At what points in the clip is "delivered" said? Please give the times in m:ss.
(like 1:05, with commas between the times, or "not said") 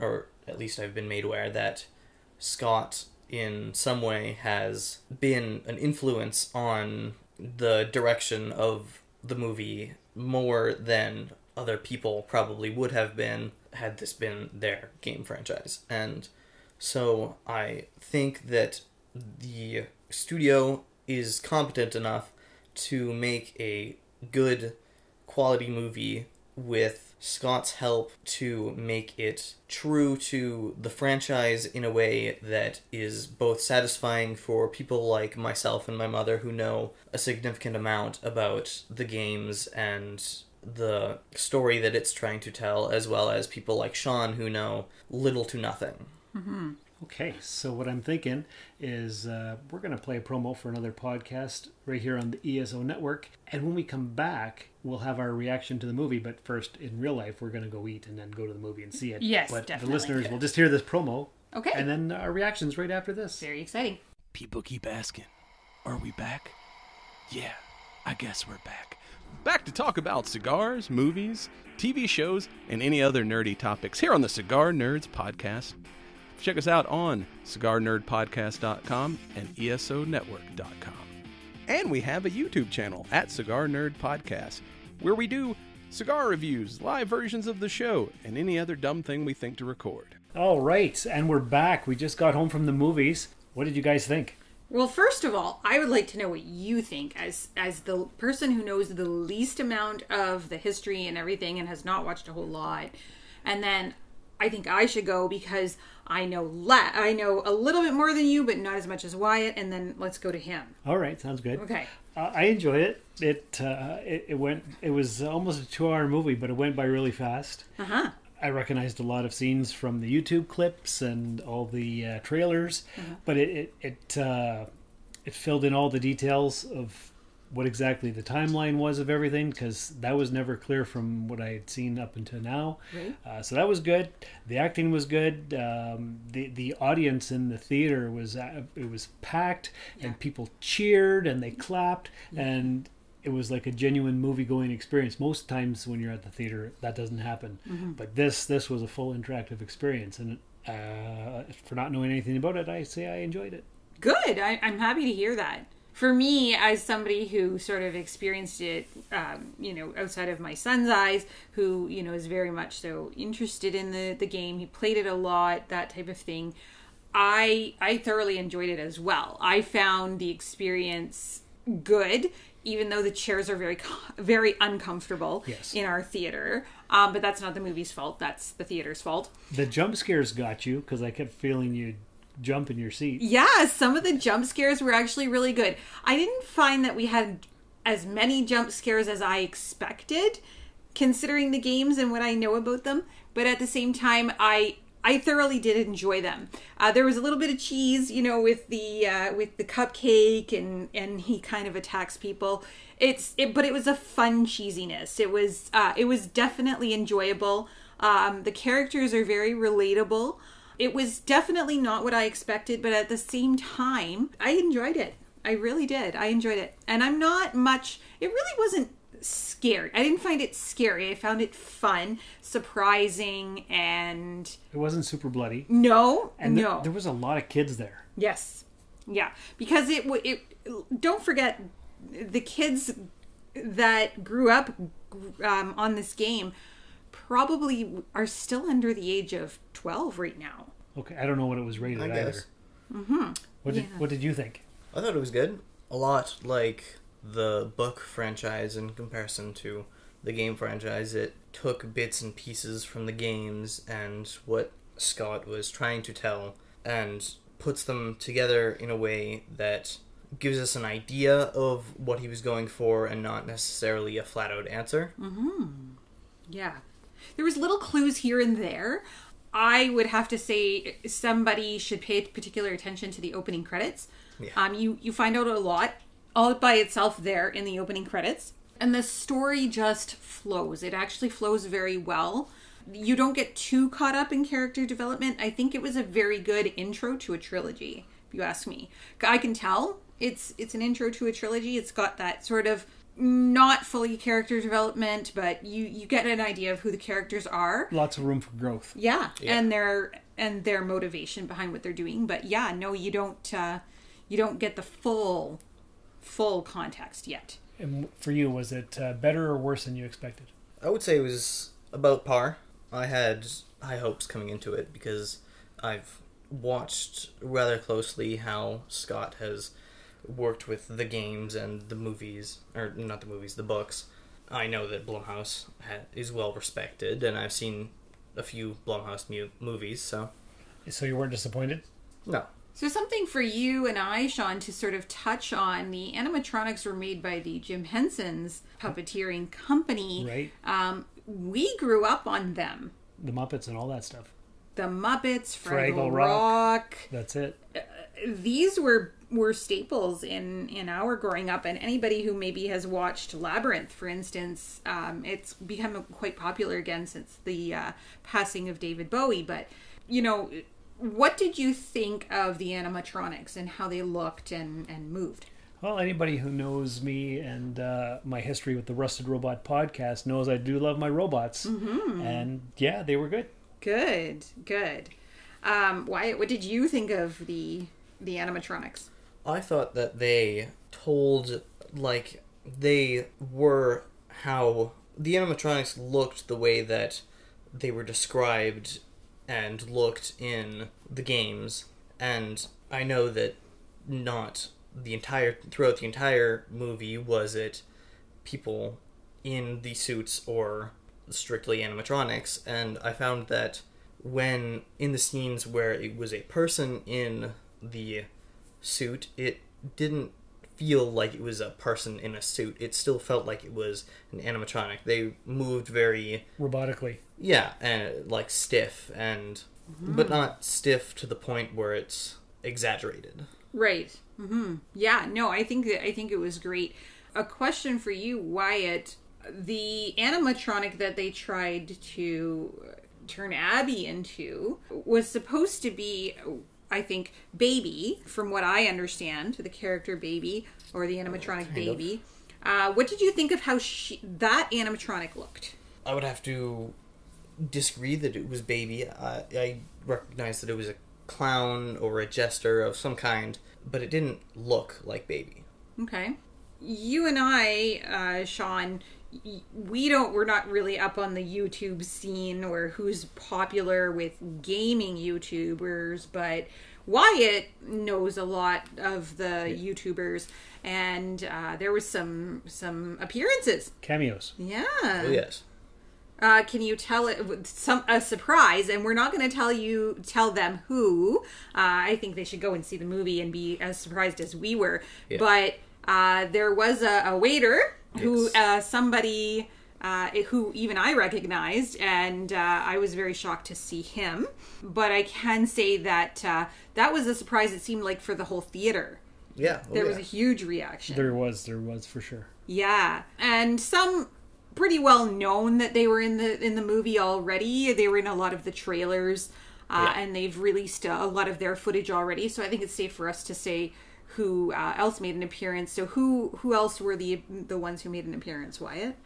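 not said.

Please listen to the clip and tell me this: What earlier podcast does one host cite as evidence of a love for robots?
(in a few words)
Rusted Robot Podcast.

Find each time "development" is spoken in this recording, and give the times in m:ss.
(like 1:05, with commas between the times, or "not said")
4:44, 4:54.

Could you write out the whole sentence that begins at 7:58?
And we're not going to tell you tell them who.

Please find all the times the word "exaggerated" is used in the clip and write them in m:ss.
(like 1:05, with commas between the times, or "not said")
7:02.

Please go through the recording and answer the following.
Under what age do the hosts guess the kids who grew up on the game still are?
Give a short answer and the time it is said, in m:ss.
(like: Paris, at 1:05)
12, at 3:59.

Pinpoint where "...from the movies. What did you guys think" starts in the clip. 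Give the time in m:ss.
1:32.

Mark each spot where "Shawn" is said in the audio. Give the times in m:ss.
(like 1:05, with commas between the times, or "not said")
0:43, 5:34, 7:38.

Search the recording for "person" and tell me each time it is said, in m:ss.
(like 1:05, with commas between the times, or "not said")
1:38, 6:46, 6:51.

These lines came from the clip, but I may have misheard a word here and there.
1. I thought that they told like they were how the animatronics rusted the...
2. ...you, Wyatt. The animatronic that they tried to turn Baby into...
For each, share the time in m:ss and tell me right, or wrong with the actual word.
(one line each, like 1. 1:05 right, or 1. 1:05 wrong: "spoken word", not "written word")
1. 6:19 wrong: "looked", not "rusted"
2. 7:08 wrong: "Abby", not "Baby".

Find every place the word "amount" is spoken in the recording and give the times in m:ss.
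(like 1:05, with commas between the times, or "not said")
0:37, 1:39.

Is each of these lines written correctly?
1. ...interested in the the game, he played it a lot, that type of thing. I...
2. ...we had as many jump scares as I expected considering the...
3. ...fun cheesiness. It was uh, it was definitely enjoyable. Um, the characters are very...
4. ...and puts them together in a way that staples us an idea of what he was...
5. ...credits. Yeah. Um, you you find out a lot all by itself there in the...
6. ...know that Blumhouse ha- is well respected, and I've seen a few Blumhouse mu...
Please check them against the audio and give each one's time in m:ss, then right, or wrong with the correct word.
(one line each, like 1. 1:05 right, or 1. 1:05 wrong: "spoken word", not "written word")
1. 2:43 right
2. 3:06 right
3. 3:23 right
4. 4:16 wrong: "gives", not "staples"
5. 4:33 right
6. 5:24 right.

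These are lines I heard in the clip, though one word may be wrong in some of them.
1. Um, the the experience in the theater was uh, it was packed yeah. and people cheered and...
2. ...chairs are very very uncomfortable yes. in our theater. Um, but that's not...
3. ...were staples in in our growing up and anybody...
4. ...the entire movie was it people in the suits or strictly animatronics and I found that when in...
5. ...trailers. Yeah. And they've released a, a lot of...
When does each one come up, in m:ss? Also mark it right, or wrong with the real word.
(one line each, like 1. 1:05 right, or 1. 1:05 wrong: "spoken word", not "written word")
1. 2:15 wrong: "audience", not "experience"
2. 2:53 right
3. 5:49 right
4. 6:35 right
5. 8:28 right.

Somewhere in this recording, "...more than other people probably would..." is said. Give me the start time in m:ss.
0:10.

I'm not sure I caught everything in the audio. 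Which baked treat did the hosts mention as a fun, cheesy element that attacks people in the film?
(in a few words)
cupcake.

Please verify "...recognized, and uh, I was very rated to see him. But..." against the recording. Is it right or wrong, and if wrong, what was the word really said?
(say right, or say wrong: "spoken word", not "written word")
wrong: "shocked", not "rated".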